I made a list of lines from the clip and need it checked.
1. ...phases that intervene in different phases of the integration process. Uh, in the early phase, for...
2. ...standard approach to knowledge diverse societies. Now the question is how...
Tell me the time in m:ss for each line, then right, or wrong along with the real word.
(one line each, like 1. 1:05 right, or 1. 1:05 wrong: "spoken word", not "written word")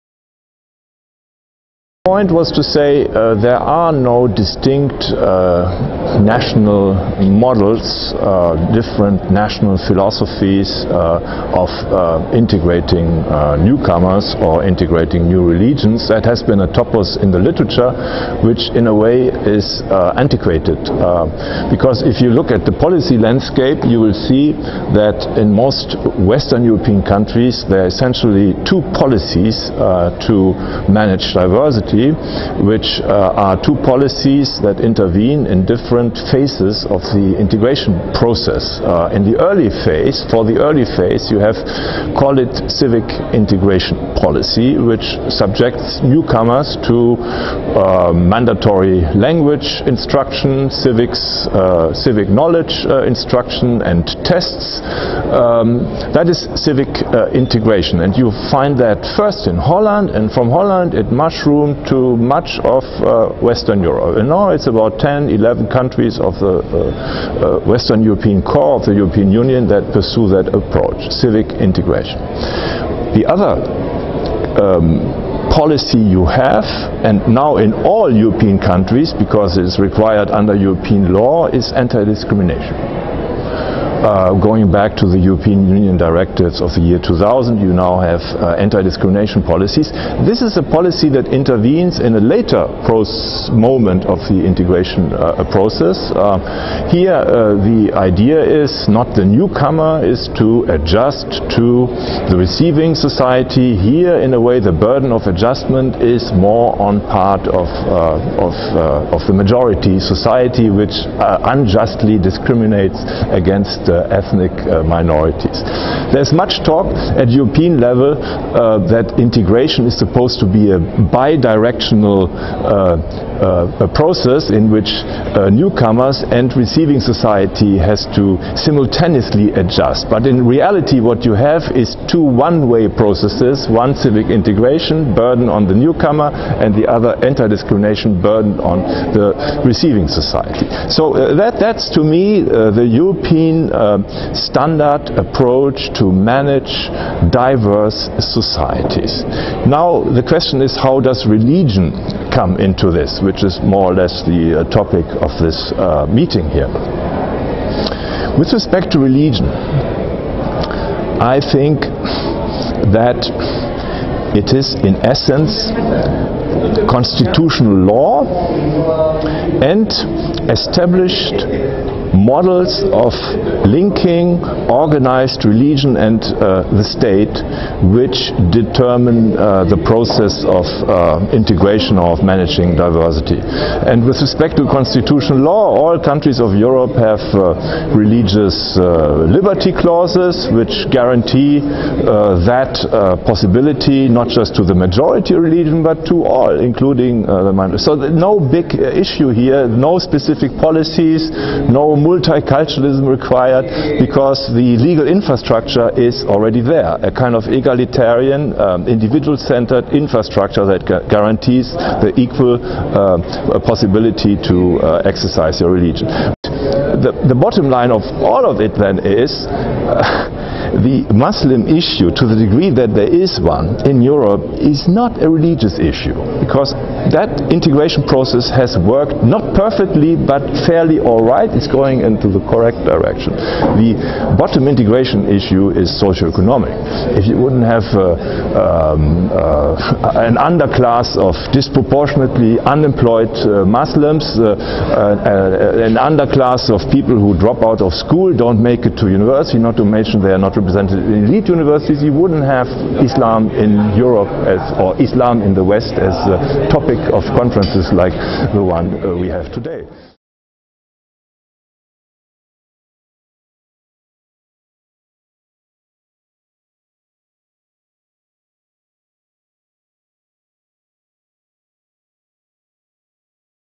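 1. 0:33 wrong: "policies", not "phases"
2. 2:24 wrong: "manage", not "knowledge".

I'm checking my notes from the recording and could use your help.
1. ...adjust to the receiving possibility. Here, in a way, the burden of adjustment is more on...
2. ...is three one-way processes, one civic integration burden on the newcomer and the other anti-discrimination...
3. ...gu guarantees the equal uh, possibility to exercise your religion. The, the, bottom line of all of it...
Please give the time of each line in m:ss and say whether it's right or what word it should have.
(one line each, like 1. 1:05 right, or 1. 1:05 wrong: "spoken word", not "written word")
1. 1:40 wrong: "society", not "possibility"
2. 2:11 wrong: "two", not "three"
3. 3:30 right.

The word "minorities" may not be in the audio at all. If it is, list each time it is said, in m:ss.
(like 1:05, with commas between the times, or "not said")
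1:54, 3:17.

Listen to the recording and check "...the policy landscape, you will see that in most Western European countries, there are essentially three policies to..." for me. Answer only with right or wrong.
wrong.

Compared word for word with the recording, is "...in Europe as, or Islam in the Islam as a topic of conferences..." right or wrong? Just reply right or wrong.
wrong.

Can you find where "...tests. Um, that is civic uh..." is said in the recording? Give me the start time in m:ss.
0:54.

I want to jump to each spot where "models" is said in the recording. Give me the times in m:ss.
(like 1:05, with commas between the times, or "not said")
0:07, 2:52.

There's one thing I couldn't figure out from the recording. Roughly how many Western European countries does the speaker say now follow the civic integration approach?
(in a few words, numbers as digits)
10, 11.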